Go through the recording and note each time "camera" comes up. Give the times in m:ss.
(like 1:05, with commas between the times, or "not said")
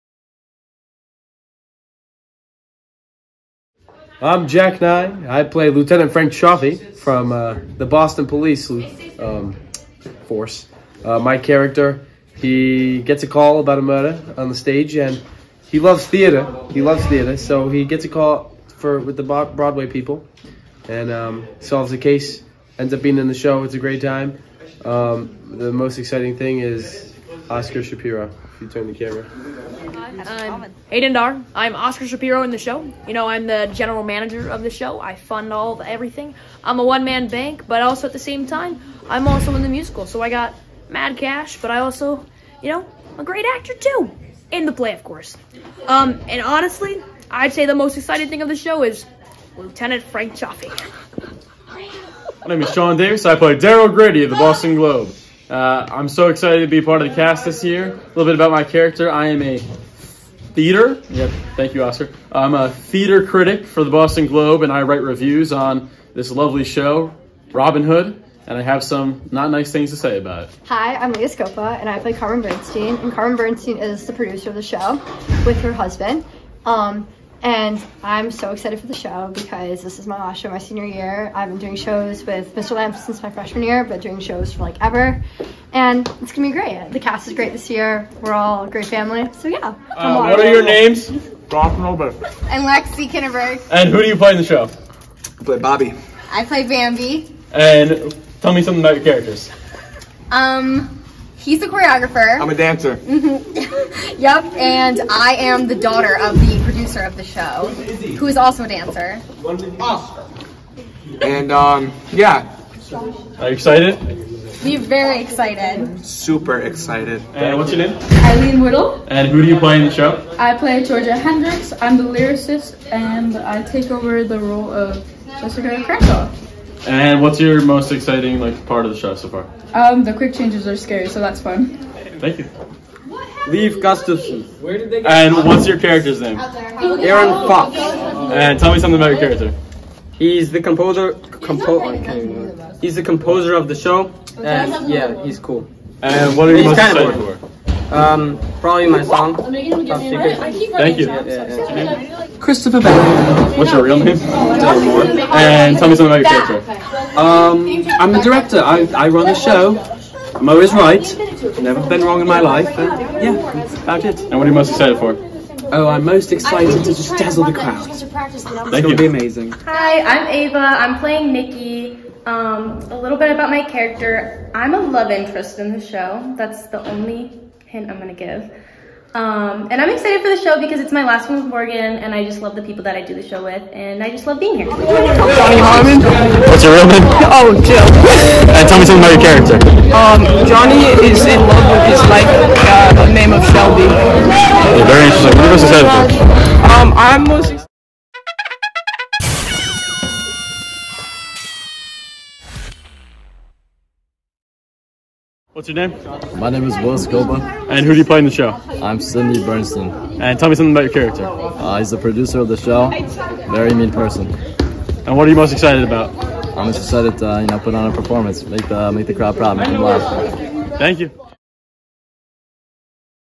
0:28.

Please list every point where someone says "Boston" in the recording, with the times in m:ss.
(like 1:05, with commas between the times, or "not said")
0:07, 0:54, 1:03.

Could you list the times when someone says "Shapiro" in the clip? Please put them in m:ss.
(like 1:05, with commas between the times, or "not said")
0:27, 0:32.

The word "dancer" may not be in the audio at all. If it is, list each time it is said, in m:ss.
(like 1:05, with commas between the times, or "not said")
1:42, 1:48.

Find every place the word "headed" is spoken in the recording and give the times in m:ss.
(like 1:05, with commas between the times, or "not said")
not said.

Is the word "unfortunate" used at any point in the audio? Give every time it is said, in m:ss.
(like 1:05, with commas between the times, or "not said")
not said.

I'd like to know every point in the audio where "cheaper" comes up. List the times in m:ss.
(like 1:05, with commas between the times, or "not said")
not said.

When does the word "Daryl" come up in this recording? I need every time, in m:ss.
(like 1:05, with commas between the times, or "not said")
0:53.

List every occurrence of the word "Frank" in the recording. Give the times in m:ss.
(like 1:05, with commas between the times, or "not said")
0:06, 0:50.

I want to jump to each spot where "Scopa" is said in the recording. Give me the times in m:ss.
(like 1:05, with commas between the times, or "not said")
1:11, 3:26.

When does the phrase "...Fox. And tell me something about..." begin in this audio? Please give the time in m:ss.
2:17.